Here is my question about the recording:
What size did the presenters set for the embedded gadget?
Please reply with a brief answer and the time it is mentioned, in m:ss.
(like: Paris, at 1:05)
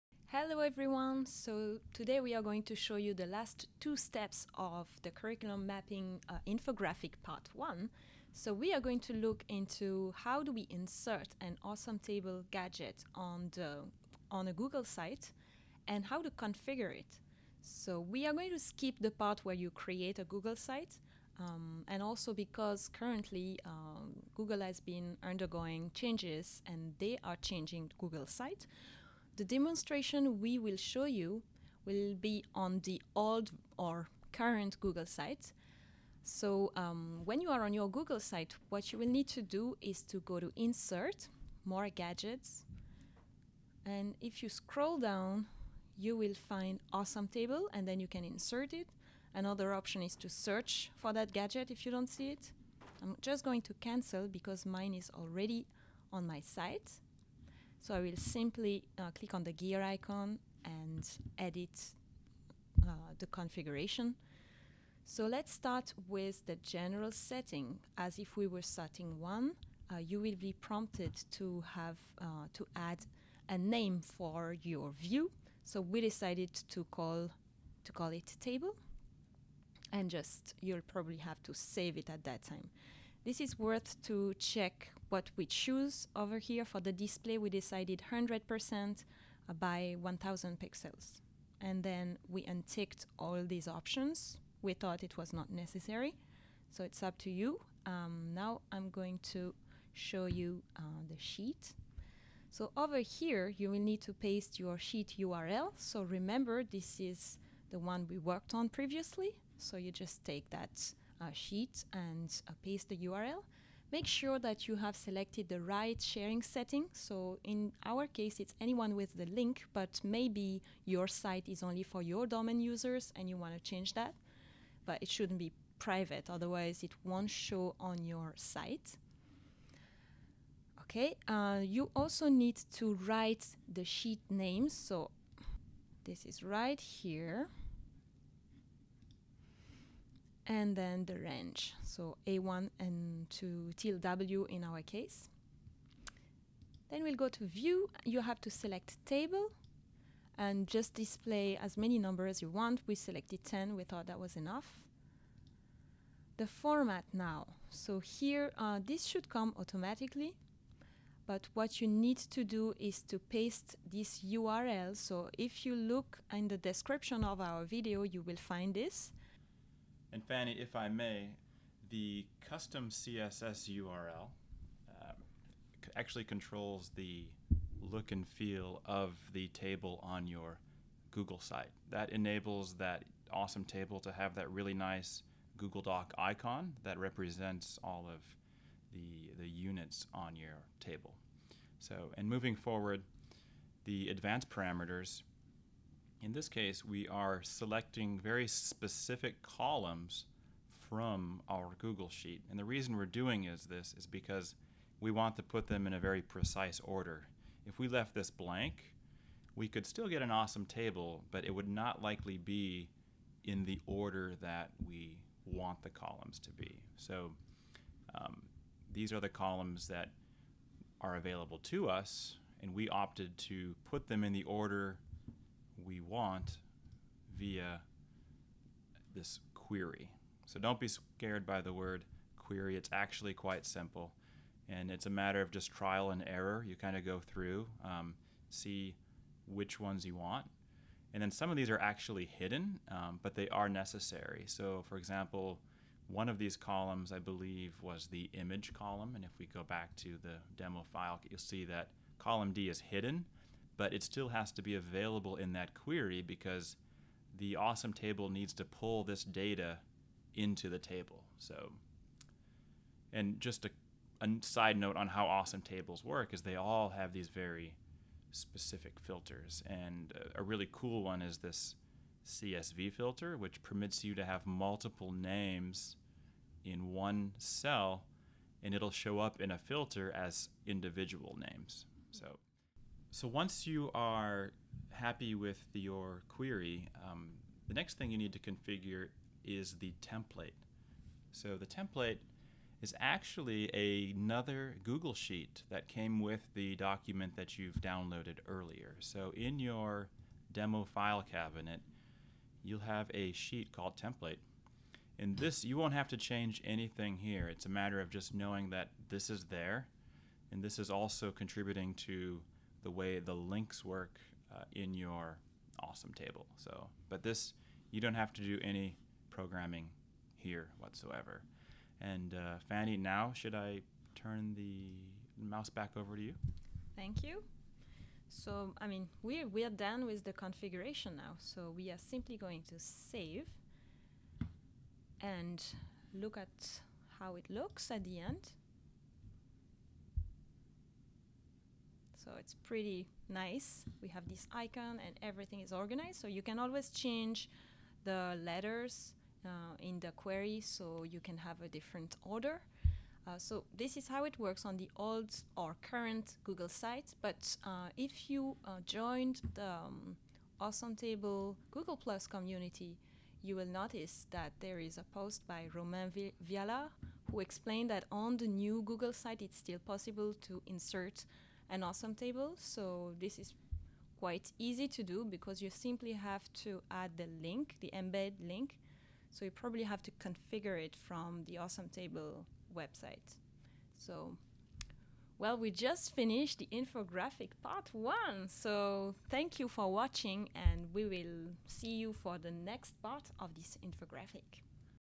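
100% by 1000 pixels, at 1:28.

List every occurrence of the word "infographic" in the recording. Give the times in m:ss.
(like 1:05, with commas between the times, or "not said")
0:06, 6:26, 6:33.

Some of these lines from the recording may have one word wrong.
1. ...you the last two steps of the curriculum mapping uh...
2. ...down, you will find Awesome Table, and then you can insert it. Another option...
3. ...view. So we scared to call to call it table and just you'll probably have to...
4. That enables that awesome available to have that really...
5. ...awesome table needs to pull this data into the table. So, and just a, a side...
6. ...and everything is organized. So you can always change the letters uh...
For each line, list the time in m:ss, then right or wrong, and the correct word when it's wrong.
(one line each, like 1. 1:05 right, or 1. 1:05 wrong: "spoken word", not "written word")
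1. 0:02 right
2. 0:44 right
3. 1:14 wrong: "decided", not "scared"
4. 3:01 wrong: "table", not "available"
5. 4:17 right
6. 5:45 right.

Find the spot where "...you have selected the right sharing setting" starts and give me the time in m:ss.
1:54.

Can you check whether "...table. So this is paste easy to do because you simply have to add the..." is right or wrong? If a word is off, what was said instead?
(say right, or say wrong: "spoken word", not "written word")
wrong: "quite", not "paste".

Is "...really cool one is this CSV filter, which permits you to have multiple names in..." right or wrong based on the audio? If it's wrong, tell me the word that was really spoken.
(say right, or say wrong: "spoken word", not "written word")
right.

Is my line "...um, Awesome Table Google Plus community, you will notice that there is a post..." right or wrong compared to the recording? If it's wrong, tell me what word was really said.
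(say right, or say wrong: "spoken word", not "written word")
right.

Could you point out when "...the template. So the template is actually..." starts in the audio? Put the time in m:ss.
4:49.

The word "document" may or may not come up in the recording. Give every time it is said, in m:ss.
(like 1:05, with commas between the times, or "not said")
4:56.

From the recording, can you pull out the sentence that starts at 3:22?
And the reason we're doing is this is because we want to put them in a very precise order.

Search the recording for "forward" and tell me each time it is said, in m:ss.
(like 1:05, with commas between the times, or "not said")
3:12.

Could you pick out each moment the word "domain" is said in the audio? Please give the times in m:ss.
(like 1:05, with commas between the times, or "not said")
2:02.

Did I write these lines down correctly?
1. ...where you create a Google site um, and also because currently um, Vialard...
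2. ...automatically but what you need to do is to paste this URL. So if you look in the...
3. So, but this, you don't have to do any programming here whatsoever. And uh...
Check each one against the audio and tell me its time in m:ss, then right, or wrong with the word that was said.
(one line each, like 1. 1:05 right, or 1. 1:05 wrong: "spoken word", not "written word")
1. 0:19 wrong: "Google", not "Vialard"
2. 2:39 right
3. 5:16 right.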